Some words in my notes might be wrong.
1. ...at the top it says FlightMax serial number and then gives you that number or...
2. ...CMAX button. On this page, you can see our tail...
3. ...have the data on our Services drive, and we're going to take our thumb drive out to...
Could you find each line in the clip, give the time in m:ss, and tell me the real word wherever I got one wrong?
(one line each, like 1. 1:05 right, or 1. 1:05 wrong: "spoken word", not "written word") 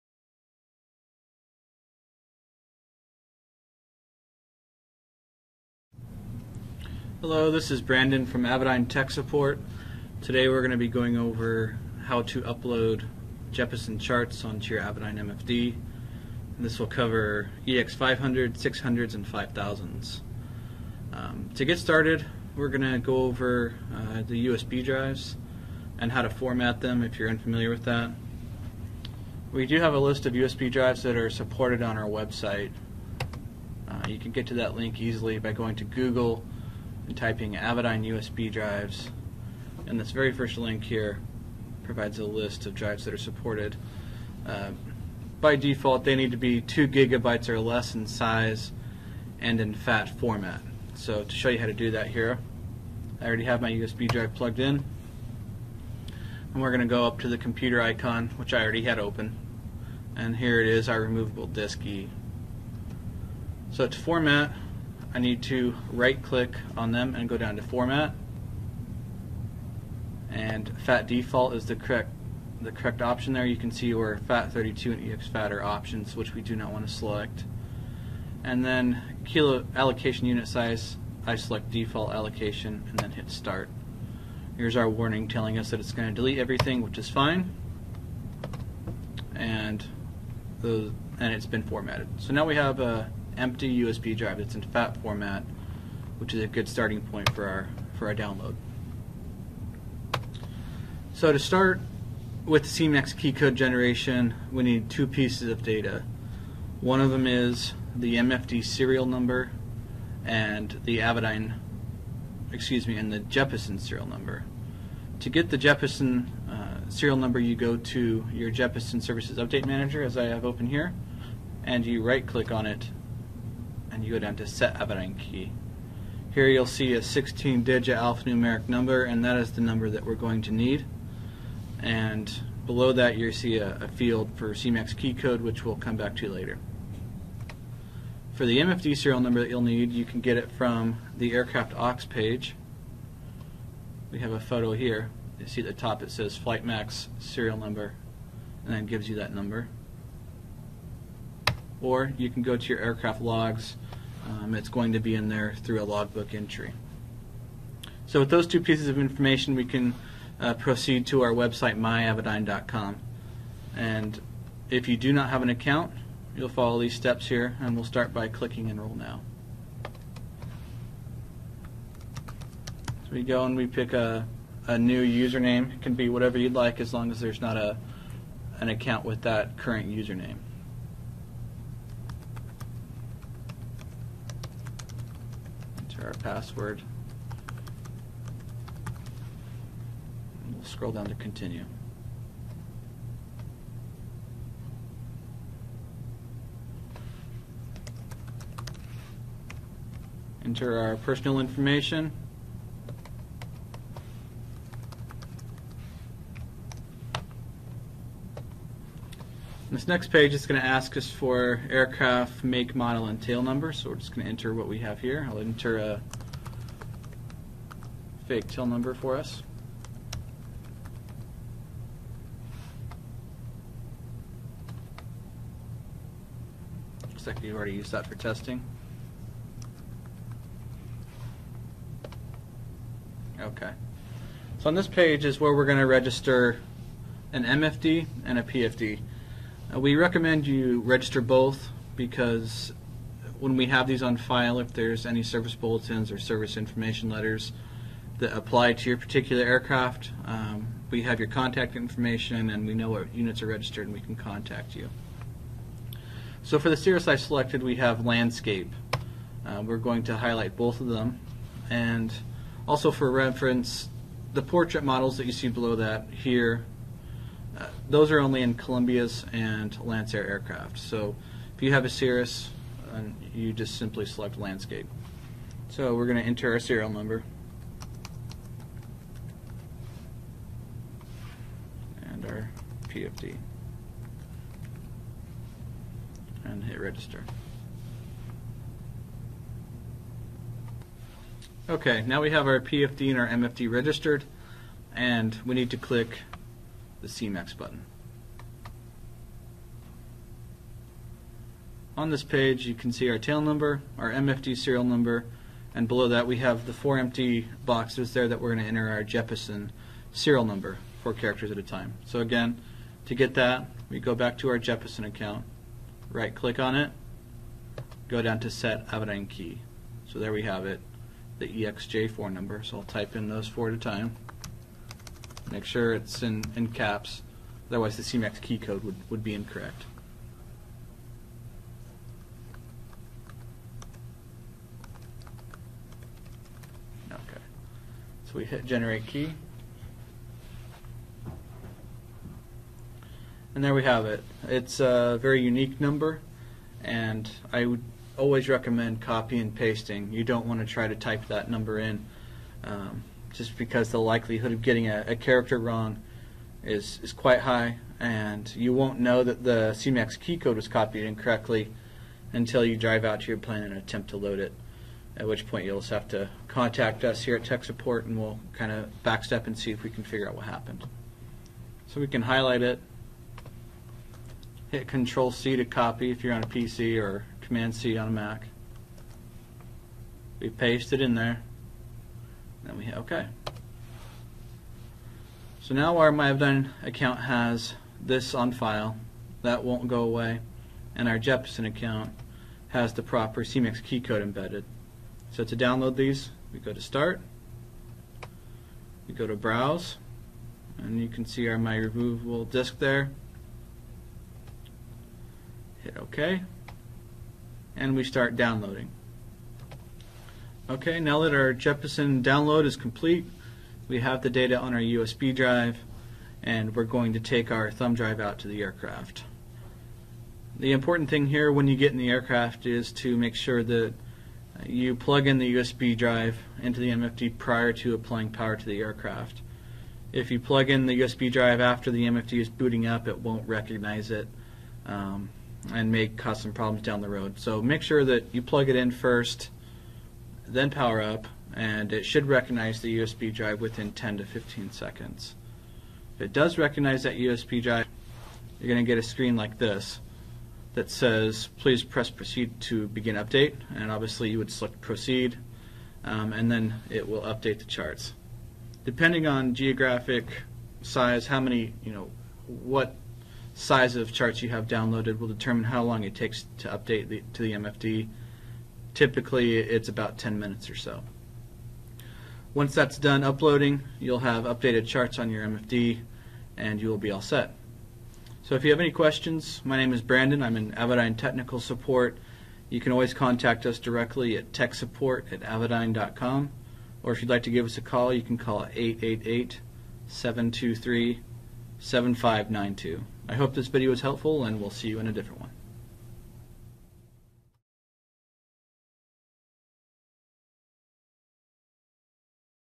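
1. 2:25 right
2. 4:57 right
3. 6:53 wrong: "USB", not "Services".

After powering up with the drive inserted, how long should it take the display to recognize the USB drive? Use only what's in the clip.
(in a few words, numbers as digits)
10 to 15 seconds.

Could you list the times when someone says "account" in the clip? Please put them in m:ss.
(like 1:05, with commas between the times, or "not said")
2:45, 2:58, 5:15, 6:26, 6:31.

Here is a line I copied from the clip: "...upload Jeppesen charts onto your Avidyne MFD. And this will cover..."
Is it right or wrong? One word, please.
right.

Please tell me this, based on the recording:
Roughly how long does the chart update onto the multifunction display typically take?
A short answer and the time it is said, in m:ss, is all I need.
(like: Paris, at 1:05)
10 minutes, at 7:50.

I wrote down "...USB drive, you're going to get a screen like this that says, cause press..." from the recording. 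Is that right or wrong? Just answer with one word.
wrong.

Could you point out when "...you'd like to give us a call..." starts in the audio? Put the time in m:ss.
8:07.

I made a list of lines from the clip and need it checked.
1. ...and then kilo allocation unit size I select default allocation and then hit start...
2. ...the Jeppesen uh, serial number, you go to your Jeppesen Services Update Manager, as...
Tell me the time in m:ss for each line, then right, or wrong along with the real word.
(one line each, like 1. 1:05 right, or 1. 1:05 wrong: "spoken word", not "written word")
1. 1:18 right
2. 1:55 right.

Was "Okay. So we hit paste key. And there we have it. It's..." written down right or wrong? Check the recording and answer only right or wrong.
wrong.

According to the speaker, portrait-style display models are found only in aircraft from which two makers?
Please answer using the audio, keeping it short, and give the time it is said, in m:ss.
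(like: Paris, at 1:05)
Columbia and Lancair, at 4:28.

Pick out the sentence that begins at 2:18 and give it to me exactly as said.
For the MFD serial number that you'll need you can get it from the aircraft aux page.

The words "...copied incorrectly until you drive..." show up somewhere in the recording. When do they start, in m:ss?
6:00.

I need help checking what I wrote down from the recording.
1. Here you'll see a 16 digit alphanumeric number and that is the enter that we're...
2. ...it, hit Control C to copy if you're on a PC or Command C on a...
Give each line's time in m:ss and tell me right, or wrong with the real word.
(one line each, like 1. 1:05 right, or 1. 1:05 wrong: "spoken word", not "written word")
1. 2:06 wrong: "number", not "enter"
2. 6:12 right.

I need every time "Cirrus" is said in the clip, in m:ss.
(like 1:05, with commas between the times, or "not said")
4:16, 4:31.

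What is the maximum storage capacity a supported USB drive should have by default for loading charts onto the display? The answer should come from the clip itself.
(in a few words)
2 gigabytes.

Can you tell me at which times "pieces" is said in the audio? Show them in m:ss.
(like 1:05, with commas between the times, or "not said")
1:45, 2:38.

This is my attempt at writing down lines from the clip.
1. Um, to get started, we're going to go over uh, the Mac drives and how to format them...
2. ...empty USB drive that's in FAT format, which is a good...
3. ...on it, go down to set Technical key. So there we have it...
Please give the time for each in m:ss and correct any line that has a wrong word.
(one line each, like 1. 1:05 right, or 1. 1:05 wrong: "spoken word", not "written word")
1. 0:21 wrong: "USB", not "Mac"
2. 1:33 right
3. 5:16 wrong: "Avidyne", not "Technical".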